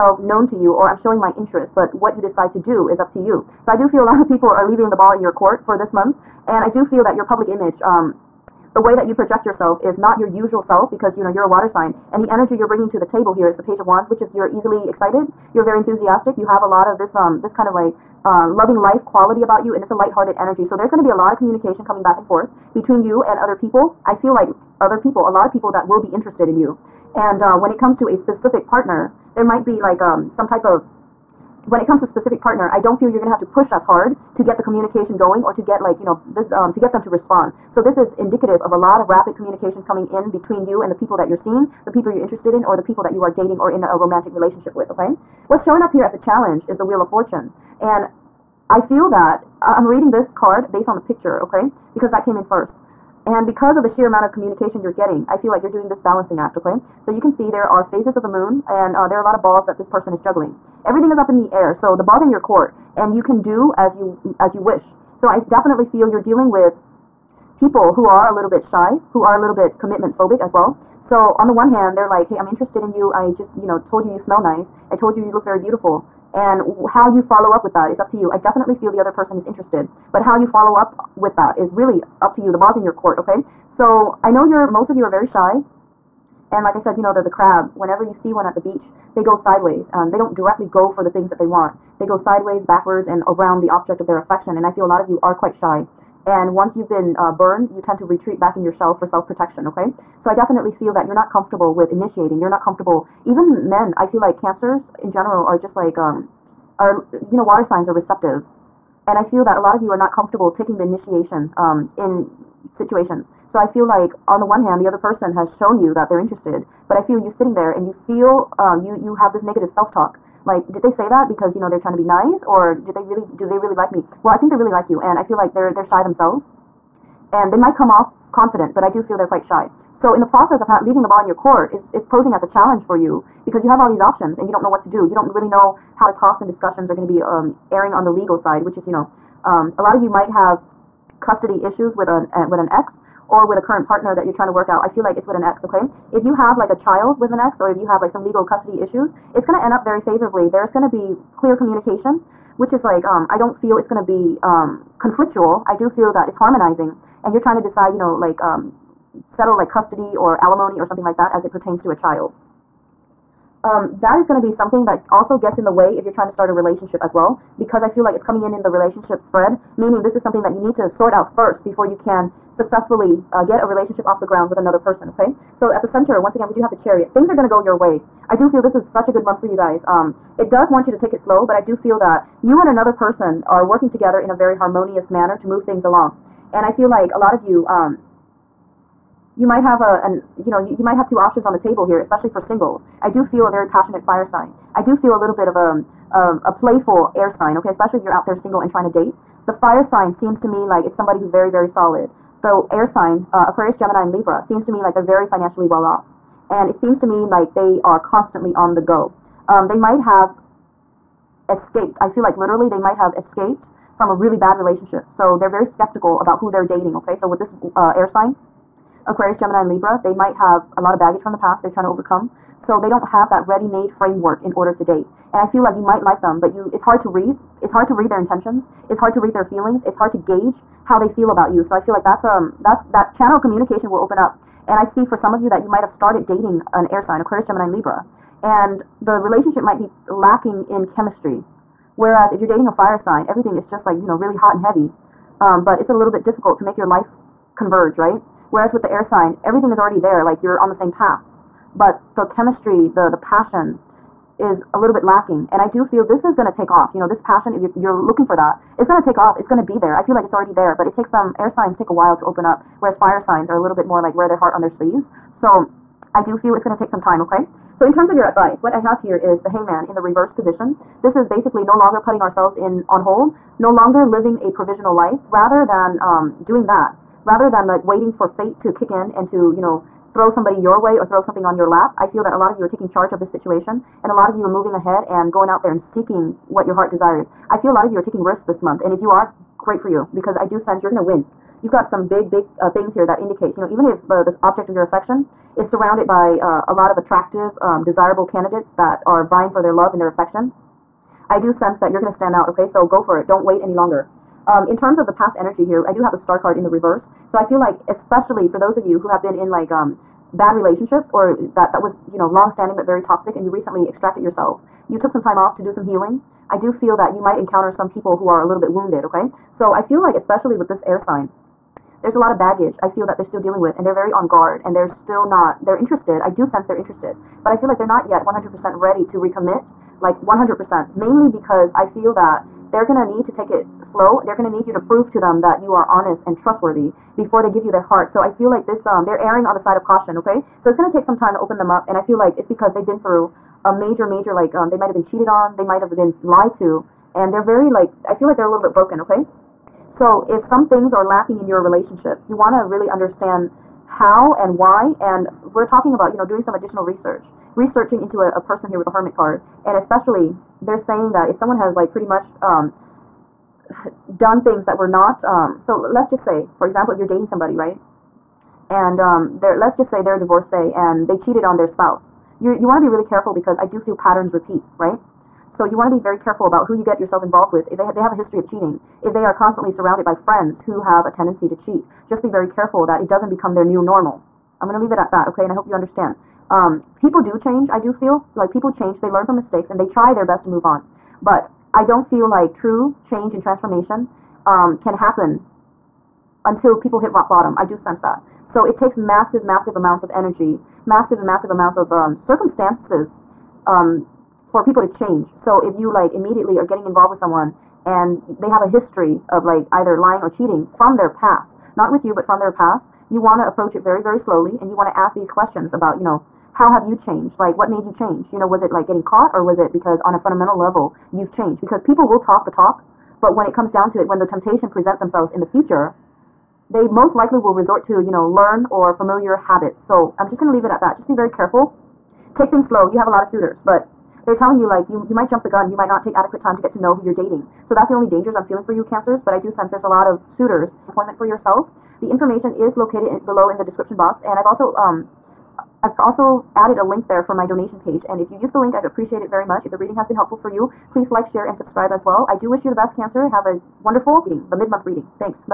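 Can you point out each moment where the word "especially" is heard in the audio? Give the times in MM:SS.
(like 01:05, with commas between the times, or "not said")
03:11, 03:17, 05:07, 05:20, 05:59.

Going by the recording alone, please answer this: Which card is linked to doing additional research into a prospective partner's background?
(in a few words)
The Hermit.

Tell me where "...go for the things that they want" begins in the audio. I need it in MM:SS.
01:30.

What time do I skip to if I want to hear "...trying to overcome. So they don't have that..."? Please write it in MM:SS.
03:41.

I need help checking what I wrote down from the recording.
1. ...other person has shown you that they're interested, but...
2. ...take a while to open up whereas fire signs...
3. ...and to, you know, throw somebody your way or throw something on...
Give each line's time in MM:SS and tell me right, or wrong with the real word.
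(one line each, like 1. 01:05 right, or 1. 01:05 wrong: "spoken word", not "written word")
1. 01:54 right
2. 04:21 right
3. 04:39 right.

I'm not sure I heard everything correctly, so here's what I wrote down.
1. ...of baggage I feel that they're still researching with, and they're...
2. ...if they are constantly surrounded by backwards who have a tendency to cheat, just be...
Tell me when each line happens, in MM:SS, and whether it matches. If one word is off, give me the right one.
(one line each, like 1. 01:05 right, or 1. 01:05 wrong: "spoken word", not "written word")
1. 05:22 wrong: "dealing", not "researching"
2. 06:19 wrong: "friends", not "backwards".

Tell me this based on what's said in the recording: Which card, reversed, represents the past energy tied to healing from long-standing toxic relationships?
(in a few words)
The Star.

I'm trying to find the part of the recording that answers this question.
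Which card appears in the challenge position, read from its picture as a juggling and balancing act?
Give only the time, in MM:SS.
00:46.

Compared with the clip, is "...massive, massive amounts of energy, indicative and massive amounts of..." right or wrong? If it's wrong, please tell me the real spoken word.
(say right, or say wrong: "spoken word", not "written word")
wrong: "massive", not "indicative".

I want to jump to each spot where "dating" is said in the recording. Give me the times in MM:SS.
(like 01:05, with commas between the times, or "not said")
00:43, 03:36, 03:56, 04:02, 06:07, 07:17.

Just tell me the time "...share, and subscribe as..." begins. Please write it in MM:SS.
07:31.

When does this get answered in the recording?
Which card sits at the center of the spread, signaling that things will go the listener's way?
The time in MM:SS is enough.
02:56.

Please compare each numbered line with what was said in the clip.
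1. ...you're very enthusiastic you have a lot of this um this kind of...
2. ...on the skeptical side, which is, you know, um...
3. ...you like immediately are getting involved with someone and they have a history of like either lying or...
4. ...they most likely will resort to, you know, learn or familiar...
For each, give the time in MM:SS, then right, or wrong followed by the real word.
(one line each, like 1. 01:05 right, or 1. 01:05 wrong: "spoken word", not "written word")
1. 00:15 right
2. 02:17 wrong: "legal", not "skeptical"
3. 06:45 right
4. 07:06 right.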